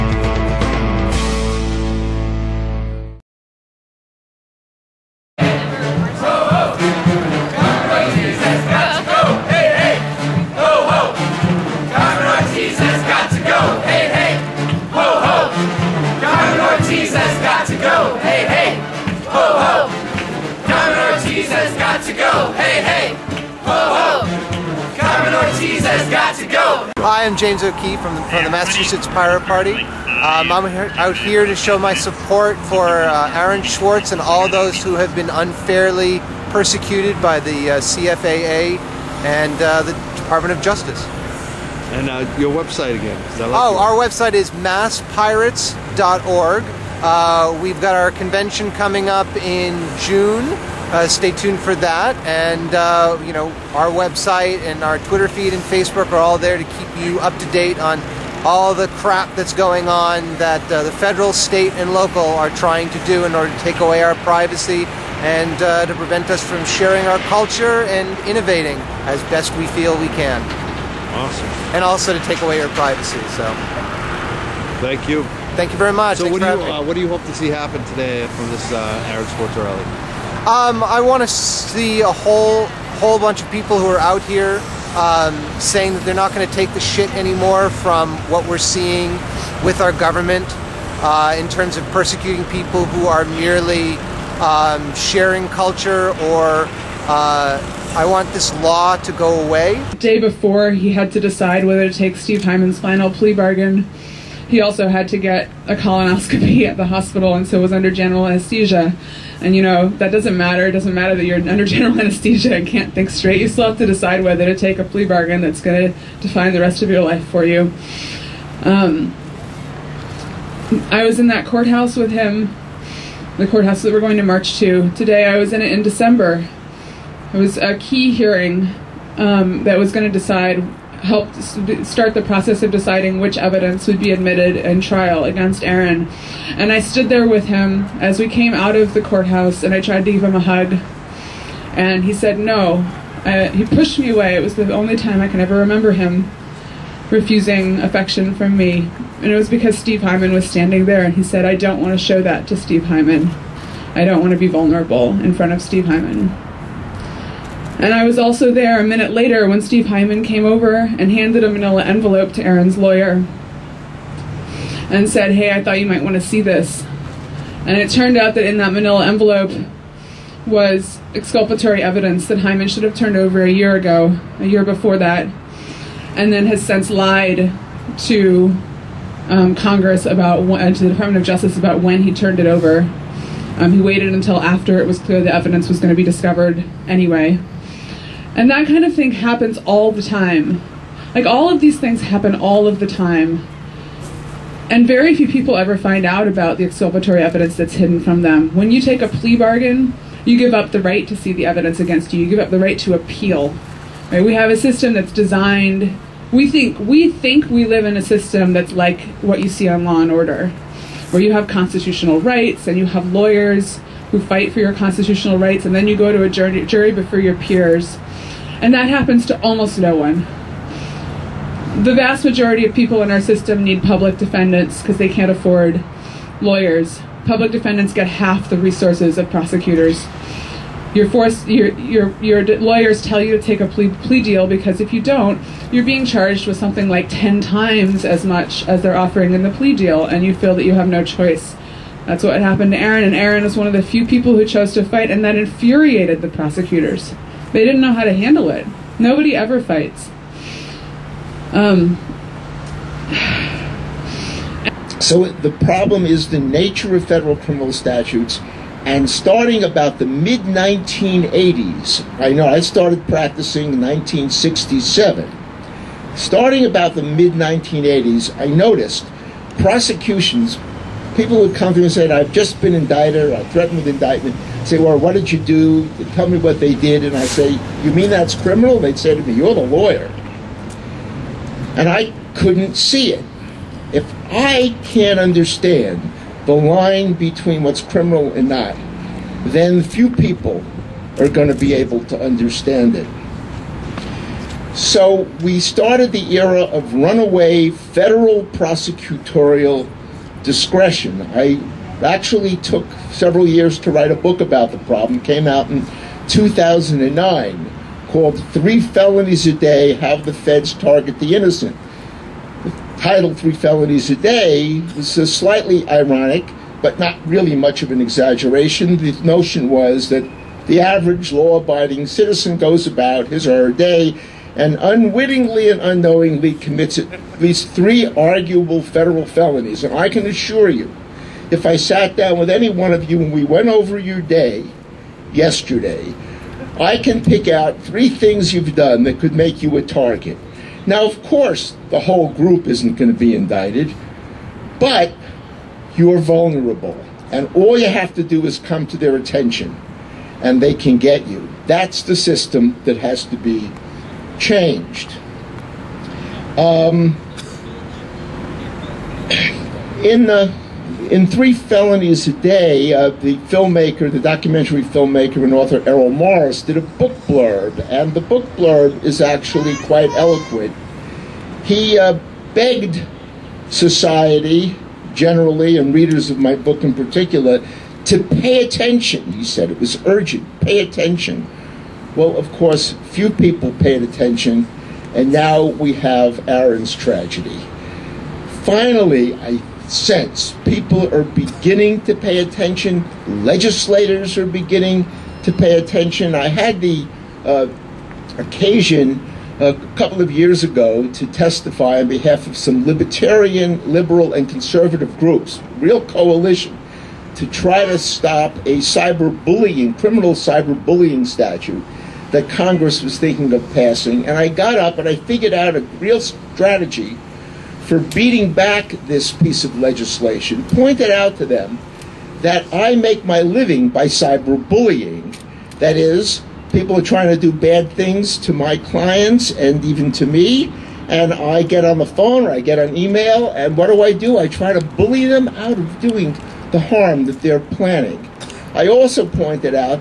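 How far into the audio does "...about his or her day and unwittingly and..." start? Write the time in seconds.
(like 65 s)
322 s.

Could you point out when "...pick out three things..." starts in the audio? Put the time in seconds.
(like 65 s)
337 s.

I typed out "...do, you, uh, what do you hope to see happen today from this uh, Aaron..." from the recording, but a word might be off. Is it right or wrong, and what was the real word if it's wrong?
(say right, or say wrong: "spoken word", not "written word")
right.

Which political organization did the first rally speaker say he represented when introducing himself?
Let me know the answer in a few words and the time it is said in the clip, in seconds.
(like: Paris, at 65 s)
Massachusetts Pirate Party, at 28 s.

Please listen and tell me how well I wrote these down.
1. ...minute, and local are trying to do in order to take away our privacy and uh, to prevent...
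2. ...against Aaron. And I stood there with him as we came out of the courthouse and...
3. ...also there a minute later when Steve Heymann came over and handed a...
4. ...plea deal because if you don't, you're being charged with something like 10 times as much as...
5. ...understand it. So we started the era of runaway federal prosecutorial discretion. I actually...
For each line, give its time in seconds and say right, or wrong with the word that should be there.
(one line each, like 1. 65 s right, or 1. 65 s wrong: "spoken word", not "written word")
1. 61 s wrong: "state", not "minute"
2. 135 s right
3. 158 s right
4. 234 s right
5. 292 s right.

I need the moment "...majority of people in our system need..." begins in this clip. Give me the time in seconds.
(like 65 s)
222 s.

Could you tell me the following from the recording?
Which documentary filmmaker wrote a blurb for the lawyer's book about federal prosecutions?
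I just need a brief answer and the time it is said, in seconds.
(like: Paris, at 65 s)
Errol Morris, at 365 s.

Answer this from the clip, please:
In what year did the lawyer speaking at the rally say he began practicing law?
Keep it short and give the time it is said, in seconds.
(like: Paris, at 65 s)
1967, at 263 s.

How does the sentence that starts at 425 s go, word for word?
That is, people are trying to do bad things to my clients and even to me.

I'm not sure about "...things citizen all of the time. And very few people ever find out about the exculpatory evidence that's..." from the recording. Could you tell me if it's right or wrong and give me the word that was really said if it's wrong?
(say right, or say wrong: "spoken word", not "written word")
wrong: "happen", not "citizen".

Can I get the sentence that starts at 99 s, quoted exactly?
The day before, he had to decide whether to take Steve Heymann's final plea bargain.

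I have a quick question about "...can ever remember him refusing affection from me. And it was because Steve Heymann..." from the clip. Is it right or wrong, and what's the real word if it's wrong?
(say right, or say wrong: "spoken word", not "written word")
right.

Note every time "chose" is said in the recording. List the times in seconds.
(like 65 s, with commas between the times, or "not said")
244 s.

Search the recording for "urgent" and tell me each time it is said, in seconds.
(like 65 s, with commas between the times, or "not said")
380 s.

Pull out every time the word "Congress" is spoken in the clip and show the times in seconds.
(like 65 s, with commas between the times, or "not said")
179 s, 412 s.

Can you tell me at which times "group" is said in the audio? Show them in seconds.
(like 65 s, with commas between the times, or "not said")
342 s, 405 s.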